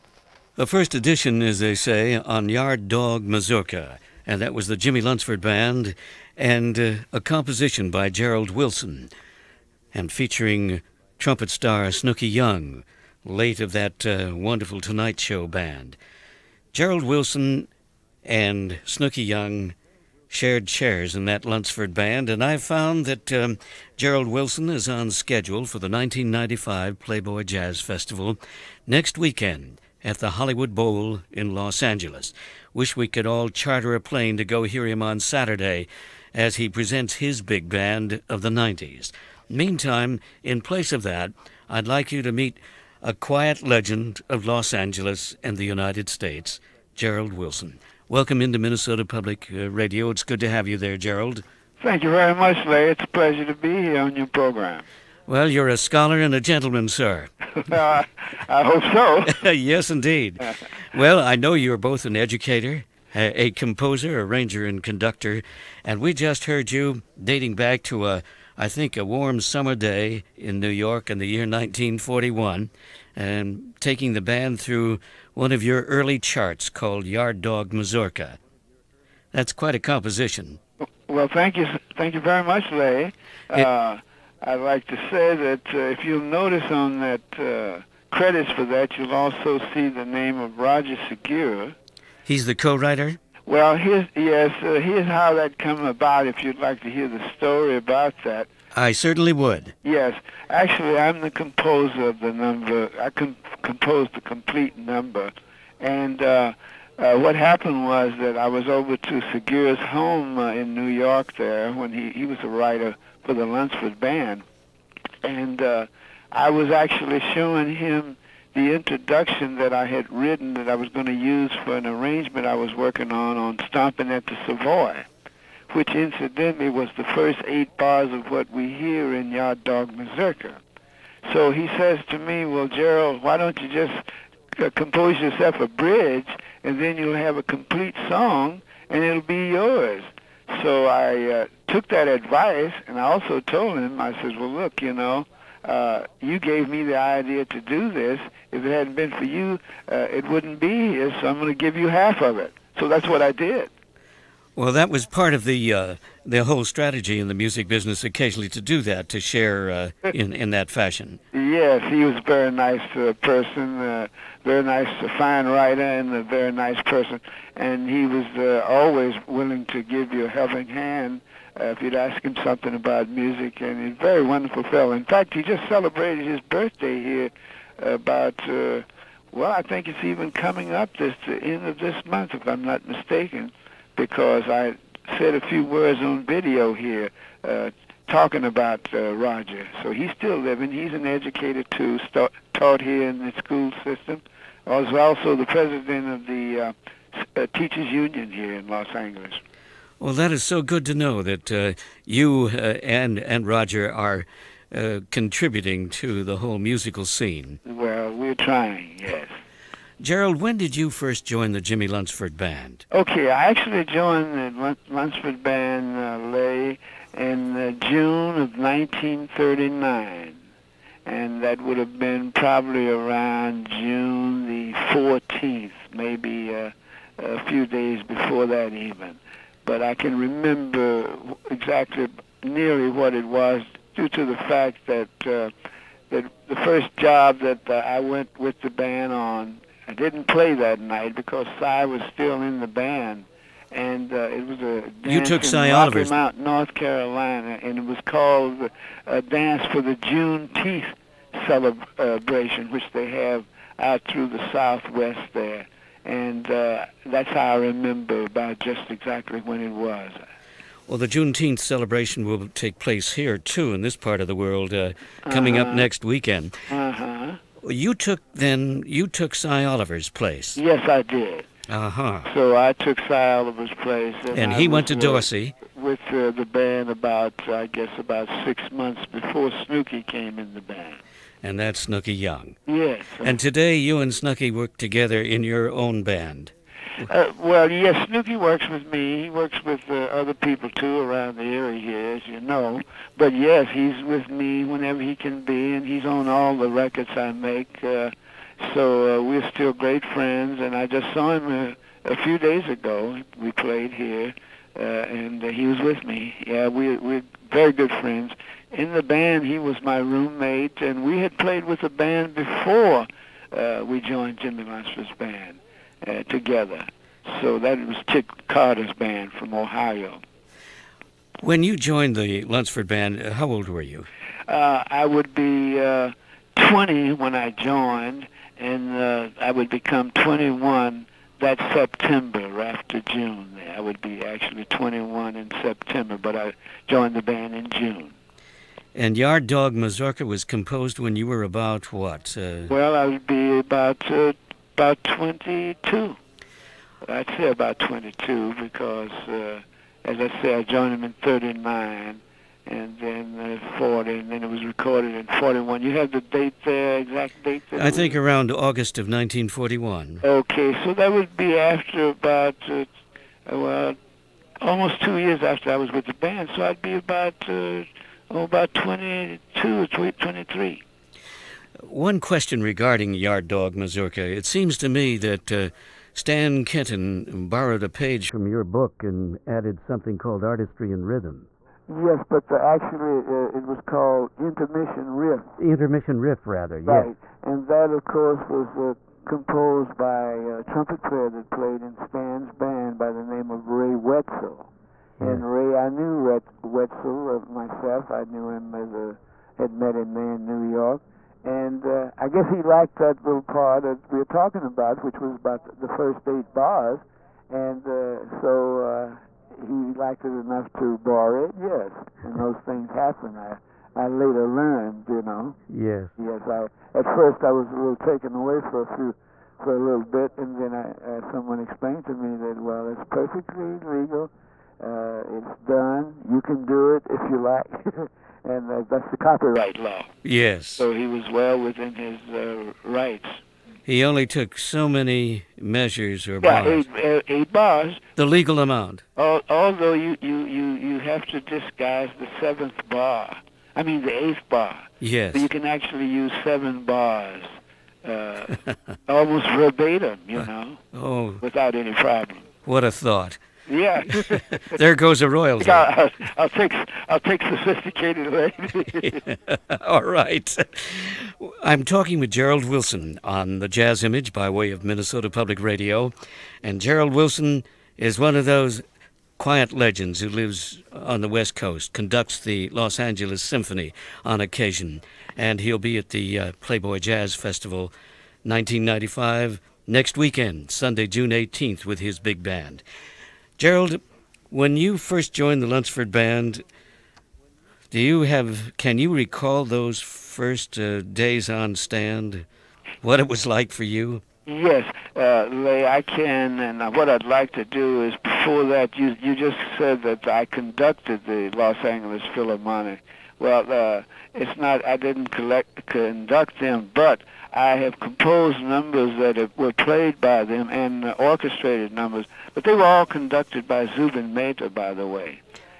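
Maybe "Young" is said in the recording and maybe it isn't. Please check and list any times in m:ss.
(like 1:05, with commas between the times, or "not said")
0:12, 0:19, 4:42.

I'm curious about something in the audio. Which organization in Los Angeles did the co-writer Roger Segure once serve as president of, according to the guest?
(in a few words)
Teachers Union.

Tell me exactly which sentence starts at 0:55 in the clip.
Well, you're a scholar and a gentleman, sir.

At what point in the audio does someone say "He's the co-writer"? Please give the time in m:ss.
1:32.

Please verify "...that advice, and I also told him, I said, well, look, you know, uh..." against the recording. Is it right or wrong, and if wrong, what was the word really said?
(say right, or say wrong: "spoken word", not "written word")
right.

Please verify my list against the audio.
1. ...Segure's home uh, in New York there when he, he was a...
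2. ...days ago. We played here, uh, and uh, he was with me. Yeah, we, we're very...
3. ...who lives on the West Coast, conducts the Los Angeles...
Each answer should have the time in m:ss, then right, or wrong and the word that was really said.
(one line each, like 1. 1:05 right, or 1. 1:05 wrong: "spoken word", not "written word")
1. 1:49 right
2. 5:02 right
3. 7:50 right.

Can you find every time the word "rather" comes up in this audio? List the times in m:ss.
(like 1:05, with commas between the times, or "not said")
6:26.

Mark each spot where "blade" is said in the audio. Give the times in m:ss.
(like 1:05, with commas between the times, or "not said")
not said.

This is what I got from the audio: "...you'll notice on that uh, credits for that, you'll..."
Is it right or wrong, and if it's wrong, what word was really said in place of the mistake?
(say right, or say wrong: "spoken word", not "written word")
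right.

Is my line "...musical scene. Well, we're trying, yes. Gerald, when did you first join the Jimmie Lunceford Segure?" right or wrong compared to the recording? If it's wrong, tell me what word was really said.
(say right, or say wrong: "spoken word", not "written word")
wrong: "Band", not "Segure".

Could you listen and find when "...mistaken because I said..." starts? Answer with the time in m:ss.
3:02.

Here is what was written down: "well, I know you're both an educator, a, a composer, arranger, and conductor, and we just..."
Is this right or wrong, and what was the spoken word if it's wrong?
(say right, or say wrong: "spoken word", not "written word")
right.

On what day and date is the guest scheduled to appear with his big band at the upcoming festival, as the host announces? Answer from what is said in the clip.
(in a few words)
Sunday, June 18.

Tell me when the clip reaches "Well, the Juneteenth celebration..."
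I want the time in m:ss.
4:20.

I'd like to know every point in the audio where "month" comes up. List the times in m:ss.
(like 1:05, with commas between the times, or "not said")
3:02, 4:38.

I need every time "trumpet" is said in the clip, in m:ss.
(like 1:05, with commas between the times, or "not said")
0:11, 6:30.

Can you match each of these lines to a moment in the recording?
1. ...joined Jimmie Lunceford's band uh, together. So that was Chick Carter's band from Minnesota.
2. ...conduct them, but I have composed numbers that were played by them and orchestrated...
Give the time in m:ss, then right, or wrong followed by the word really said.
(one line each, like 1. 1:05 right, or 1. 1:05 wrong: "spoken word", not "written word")
1. 5:14 wrong: "Ohio", not "Minnesota"
2. 8:25 right.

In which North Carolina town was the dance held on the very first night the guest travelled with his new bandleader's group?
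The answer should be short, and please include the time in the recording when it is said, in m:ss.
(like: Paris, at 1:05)
Rocky Mount, at 4:06.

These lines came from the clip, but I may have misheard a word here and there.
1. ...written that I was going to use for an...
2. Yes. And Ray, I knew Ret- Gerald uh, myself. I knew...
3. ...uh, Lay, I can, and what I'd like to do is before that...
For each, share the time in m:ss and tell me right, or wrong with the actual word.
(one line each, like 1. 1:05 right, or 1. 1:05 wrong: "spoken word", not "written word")
1. 2:00 right
2. 6:34 wrong: "Wetzel", not "Gerald"
3. 8:15 right.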